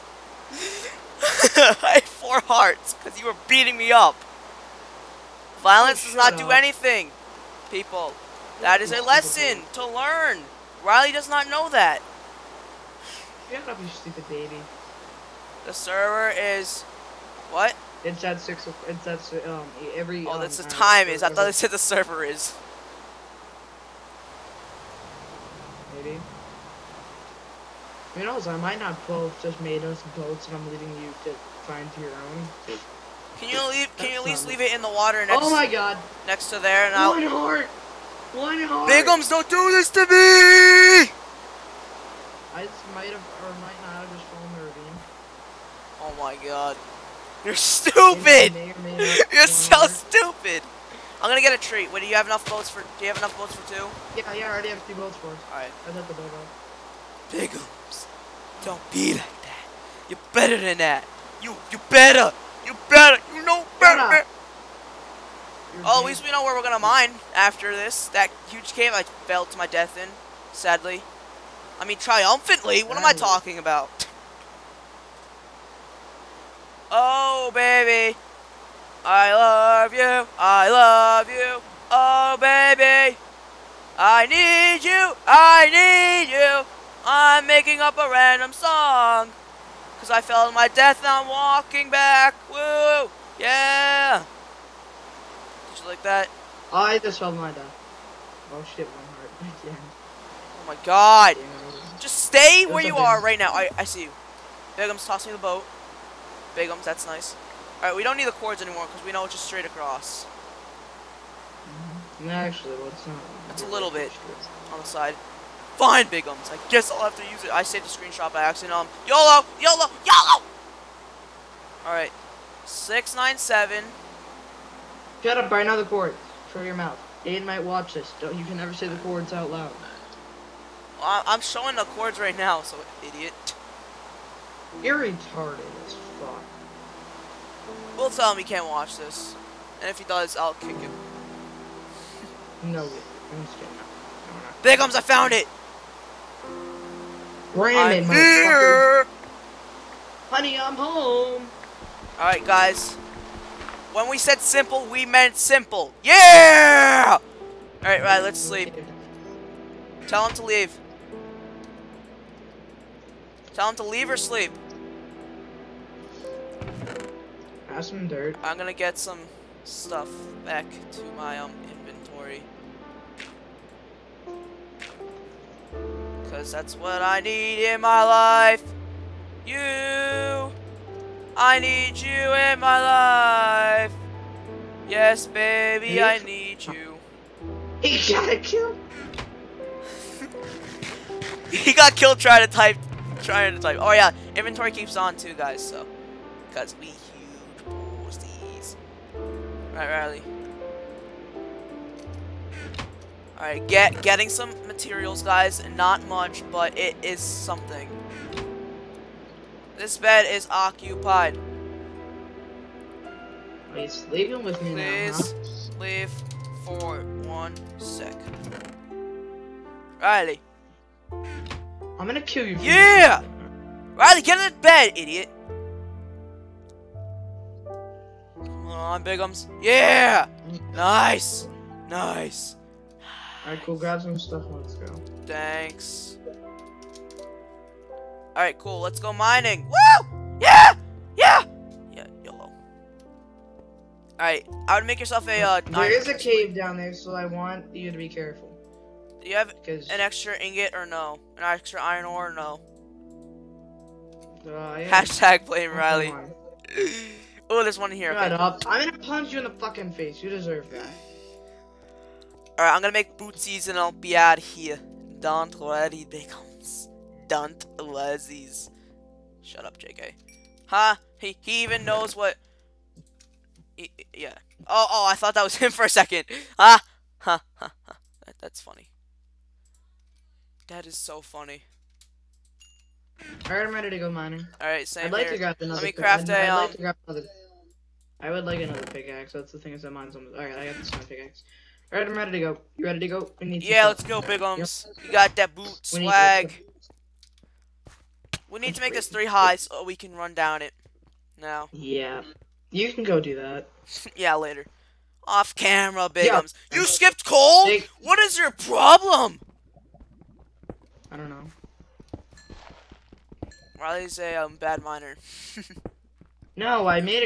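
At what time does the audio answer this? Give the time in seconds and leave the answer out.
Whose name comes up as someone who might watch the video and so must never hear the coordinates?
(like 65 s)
127 s.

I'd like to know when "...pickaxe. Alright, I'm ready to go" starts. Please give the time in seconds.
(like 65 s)
291 s.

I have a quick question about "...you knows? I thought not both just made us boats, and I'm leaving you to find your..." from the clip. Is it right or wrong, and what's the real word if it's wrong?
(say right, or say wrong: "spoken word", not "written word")
wrong: "might", not "thought".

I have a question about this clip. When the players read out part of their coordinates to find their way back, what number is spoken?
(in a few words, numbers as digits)
697.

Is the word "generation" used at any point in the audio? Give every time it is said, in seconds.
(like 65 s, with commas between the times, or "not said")
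not said.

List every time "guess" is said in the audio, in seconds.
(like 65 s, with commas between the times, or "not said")
116 s.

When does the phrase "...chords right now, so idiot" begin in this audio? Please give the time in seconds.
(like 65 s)
131 s.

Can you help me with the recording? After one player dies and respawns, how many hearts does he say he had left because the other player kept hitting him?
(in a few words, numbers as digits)
4.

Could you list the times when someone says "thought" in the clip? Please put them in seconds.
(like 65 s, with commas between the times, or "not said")
21 s, 275 s.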